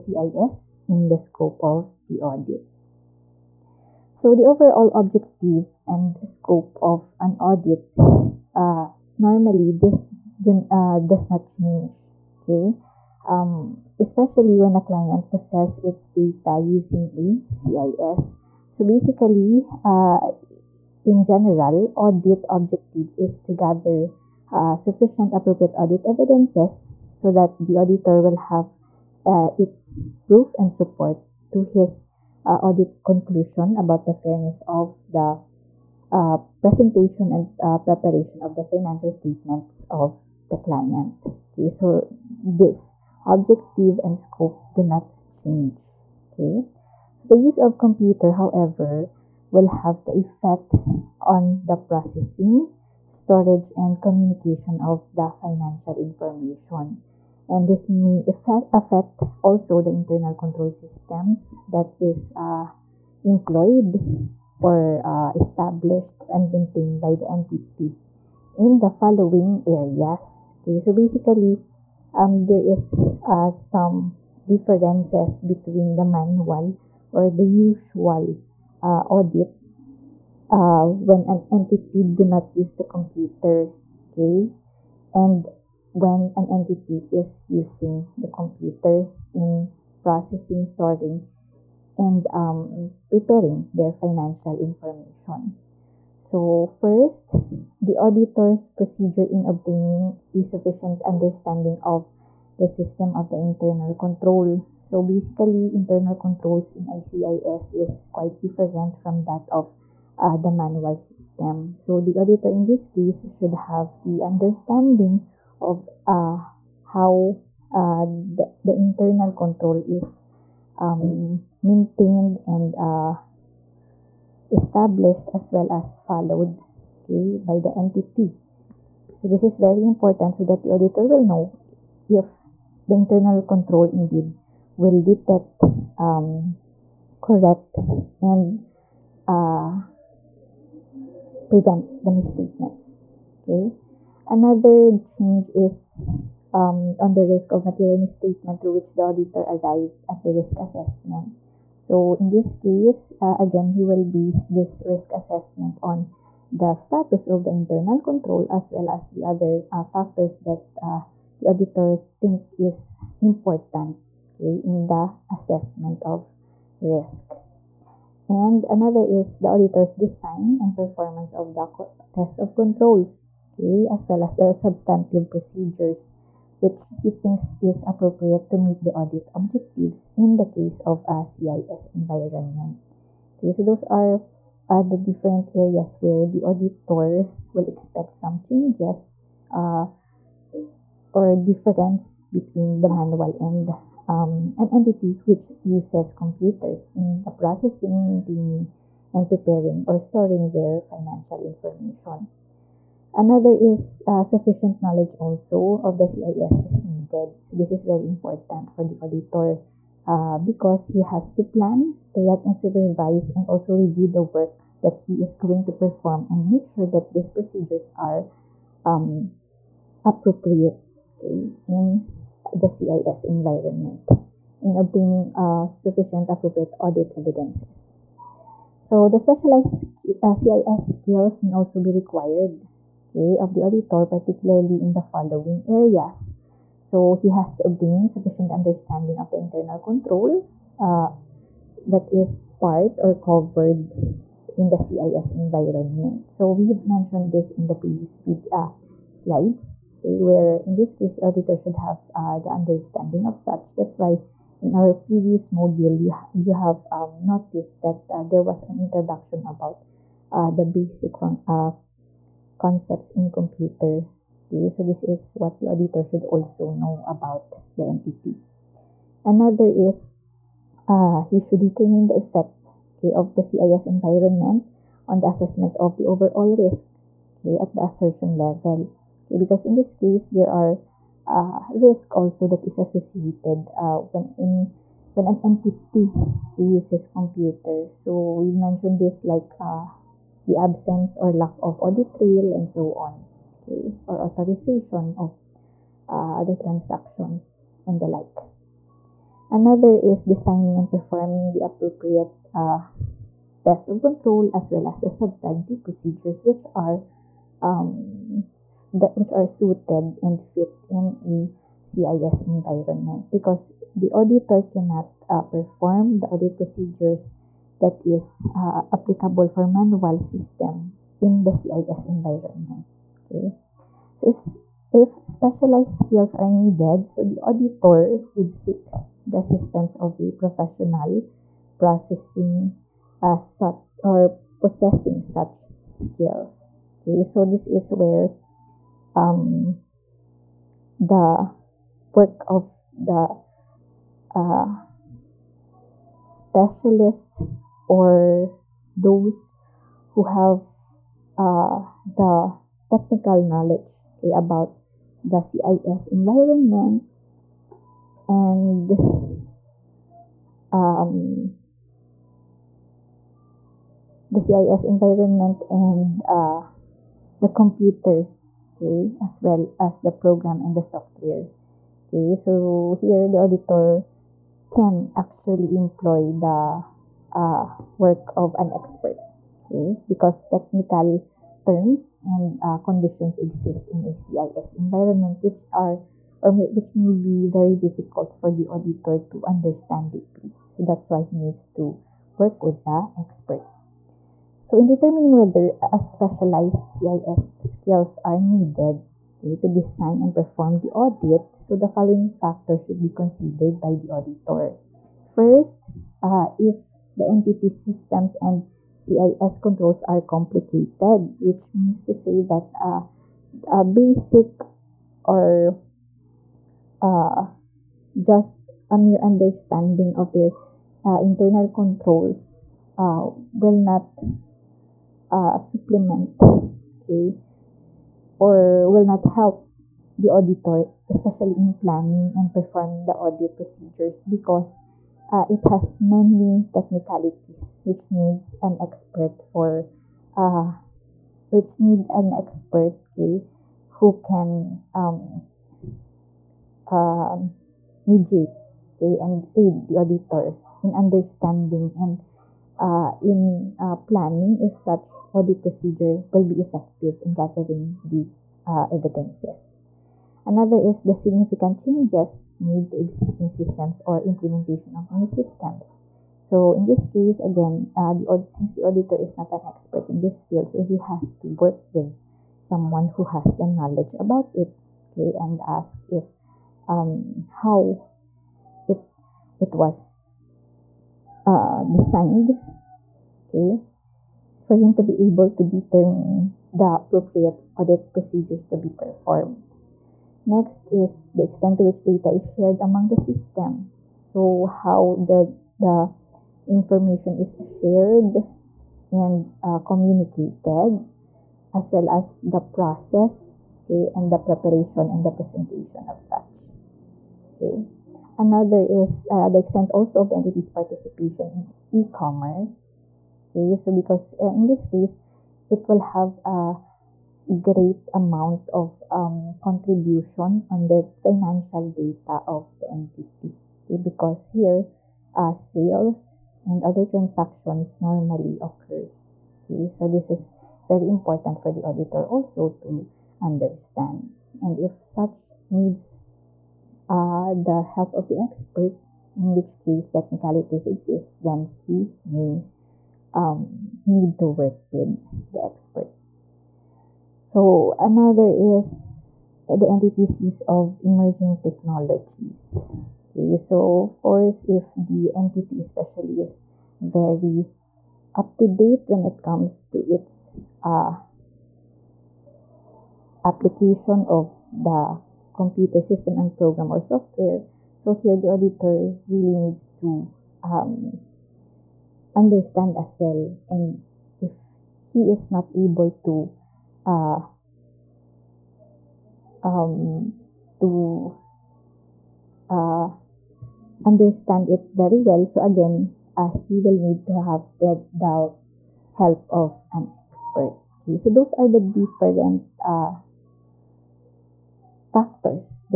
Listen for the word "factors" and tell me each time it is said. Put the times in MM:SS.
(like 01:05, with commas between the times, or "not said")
02:39, 06:42, 09:55.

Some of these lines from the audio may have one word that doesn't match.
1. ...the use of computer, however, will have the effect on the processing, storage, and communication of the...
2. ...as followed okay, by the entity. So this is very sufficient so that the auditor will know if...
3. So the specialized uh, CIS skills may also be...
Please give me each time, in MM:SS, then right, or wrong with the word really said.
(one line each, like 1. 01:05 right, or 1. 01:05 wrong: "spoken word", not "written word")
1. 00:47 right
2. 02:05 wrong: "important", not "sufficient"
3. 03:48 right.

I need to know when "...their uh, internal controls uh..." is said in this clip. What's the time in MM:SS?
07:00.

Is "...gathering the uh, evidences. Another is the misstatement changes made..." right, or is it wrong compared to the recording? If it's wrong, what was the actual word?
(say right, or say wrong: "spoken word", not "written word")
wrong: "significant", not "misstatement".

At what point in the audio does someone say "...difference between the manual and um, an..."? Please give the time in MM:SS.
03:11.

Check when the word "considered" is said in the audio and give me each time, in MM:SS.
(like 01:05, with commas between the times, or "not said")
06:43.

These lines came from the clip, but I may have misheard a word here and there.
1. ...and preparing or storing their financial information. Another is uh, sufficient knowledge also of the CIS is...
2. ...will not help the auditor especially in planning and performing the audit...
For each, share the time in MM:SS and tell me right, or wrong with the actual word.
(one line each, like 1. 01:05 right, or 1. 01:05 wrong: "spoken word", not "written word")
1. 03:19 right
2. 07:08 right.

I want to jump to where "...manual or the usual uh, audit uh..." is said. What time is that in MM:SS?
01:16.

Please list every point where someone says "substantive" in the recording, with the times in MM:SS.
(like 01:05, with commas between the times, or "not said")
02:54, 05:05.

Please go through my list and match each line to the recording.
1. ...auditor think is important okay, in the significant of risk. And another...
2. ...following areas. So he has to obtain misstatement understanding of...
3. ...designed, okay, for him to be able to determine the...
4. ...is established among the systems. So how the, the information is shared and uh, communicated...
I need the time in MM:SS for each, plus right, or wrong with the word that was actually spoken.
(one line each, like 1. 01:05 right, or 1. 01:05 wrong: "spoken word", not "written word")
1. 02:41 wrong: "assessment", not "significant"
2. 03:55 wrong: "sufficient", not "misstatement"
3. 08:01 right
4. 08:12 wrong: "shared", not "established".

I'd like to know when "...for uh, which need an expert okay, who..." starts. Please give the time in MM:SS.
07:19.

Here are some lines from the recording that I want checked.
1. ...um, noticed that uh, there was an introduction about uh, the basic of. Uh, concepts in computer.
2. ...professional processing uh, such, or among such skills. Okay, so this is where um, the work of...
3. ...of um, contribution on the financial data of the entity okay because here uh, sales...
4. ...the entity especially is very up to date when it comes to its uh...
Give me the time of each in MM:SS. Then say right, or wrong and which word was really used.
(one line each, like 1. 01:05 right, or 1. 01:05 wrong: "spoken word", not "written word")
1. 04:16 right
2. 05:30 wrong: "possessing", not "among"
3. 08:38 right
4. 09:14 right.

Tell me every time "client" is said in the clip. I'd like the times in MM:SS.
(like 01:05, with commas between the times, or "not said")
00:14, 00:40.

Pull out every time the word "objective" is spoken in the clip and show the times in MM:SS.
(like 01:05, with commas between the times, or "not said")
00:04, 00:22, 00:43, 02:59.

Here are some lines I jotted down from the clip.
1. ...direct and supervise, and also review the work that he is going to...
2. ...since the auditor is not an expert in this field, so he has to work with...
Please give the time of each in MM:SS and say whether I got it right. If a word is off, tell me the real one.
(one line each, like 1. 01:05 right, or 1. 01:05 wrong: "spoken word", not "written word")
1. 03:32 right
2. 07:48 right.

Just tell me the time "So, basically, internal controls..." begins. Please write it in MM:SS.
01:44.